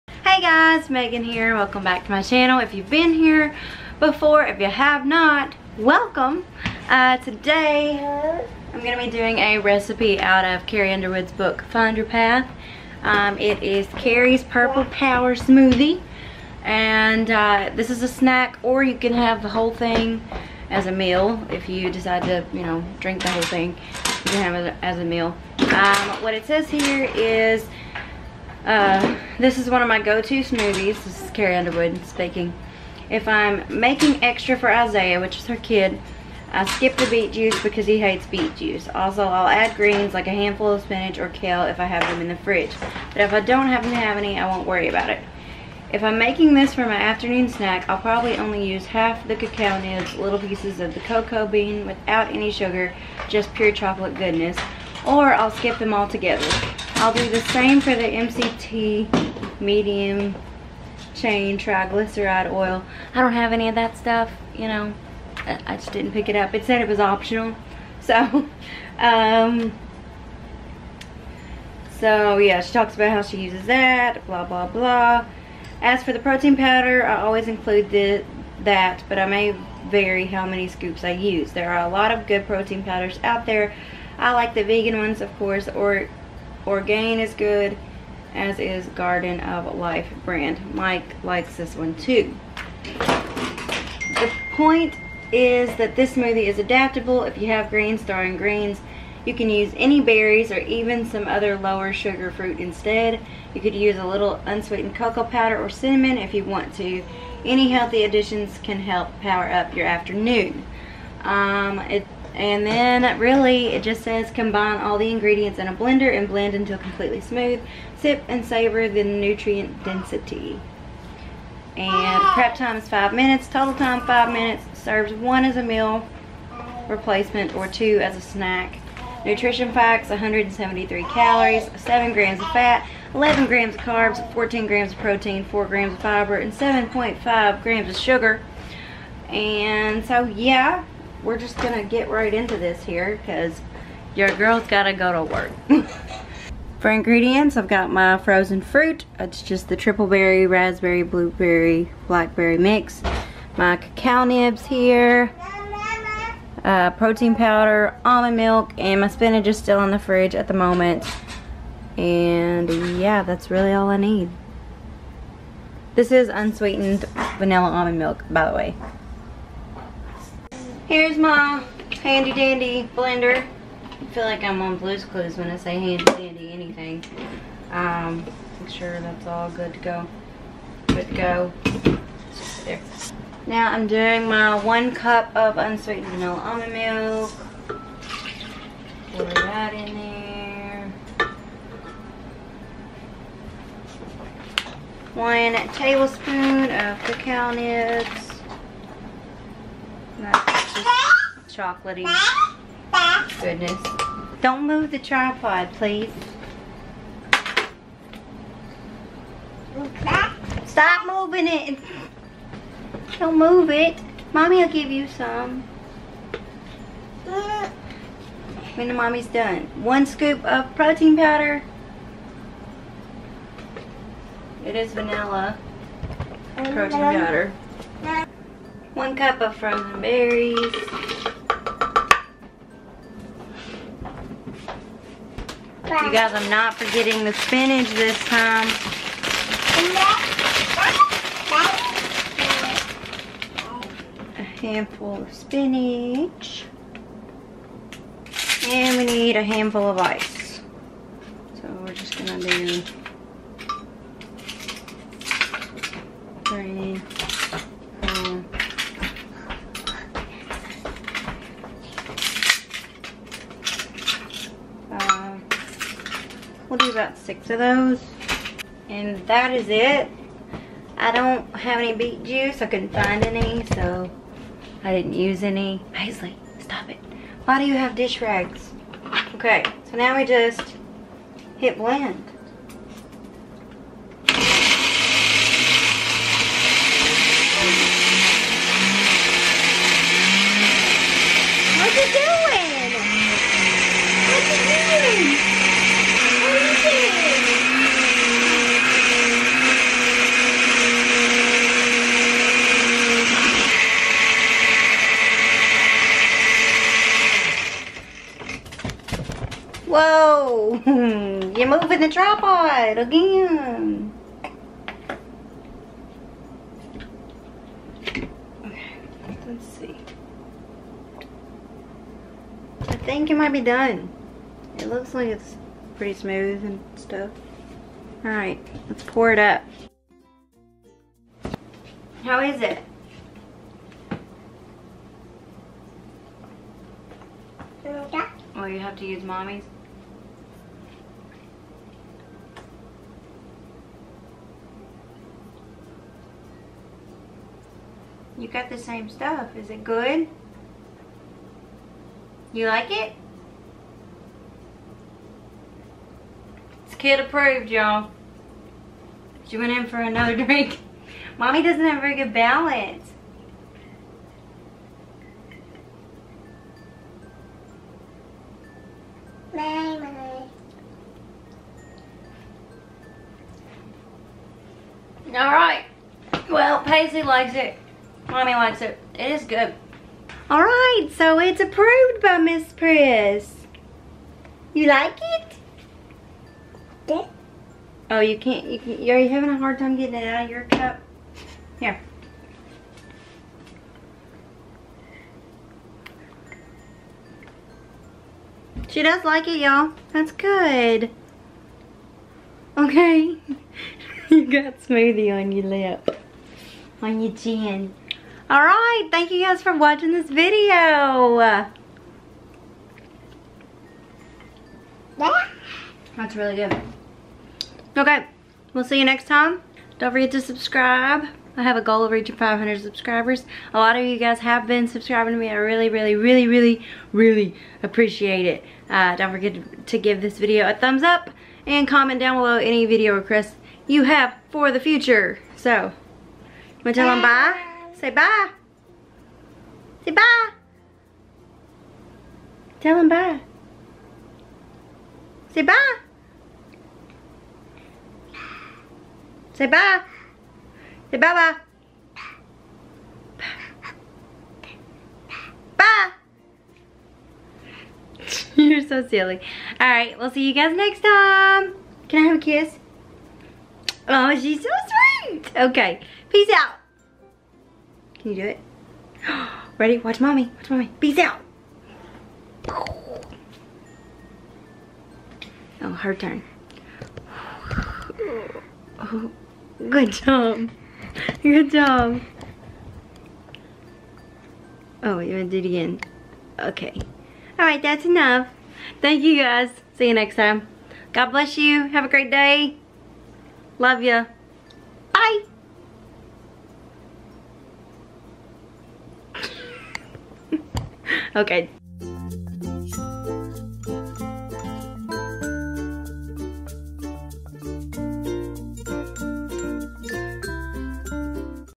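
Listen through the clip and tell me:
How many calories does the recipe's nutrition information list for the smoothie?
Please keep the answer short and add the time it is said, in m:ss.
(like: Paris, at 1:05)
173, at 2:10.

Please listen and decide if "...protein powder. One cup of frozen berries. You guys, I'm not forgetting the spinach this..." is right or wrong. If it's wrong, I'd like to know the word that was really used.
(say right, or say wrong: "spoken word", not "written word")
right.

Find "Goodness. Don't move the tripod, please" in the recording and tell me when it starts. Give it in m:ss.
3:23.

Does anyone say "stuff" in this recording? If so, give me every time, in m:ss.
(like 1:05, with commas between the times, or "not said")
1:03, 5:26, 5:49.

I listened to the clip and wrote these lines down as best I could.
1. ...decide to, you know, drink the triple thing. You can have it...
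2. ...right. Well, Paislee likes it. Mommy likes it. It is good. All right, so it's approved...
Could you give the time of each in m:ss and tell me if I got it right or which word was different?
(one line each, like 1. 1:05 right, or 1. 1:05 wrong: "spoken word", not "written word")
1. 0:21 wrong: "whole", not "triple"
2. 6:15 right.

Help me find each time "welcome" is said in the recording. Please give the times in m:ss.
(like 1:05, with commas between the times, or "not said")
0:01, 0:05.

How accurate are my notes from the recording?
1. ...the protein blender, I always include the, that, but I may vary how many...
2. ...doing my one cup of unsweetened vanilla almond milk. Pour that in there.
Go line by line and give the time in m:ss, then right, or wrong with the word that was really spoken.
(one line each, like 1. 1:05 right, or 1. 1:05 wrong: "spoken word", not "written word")
1. 1:16 wrong: "powder", not "blender"
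2. 3:03 right.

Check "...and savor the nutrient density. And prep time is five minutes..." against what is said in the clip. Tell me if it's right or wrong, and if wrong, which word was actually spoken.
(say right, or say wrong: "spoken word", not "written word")
right.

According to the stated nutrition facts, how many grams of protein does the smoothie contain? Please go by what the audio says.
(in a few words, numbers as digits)
14 grams.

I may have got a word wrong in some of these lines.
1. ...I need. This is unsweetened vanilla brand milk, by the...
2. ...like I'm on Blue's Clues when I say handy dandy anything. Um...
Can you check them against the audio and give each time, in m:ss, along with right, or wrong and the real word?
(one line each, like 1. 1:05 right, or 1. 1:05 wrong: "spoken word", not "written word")
1. 2:43 wrong: "almond", not "brand"
2. 2:54 right.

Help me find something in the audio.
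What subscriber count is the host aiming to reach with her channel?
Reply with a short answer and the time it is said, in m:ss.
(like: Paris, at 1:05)
500, at 7:02.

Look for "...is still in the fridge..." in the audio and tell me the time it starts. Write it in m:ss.
2:39.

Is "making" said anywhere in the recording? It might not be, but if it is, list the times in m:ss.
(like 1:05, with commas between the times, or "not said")
0:33, 0:46.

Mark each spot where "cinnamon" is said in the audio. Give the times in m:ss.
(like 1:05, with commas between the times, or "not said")
1:45.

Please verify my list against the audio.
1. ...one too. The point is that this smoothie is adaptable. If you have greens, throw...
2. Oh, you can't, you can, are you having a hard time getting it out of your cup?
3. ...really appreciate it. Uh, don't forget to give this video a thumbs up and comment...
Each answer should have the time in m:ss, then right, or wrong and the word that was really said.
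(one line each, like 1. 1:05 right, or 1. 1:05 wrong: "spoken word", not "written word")
1. 1:31 right
2. 6:28 right
3. 7:07 right.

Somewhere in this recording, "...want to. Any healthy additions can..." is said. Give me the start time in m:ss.
1:46.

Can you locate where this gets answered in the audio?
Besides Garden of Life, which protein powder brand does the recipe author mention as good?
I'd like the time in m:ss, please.
1:26.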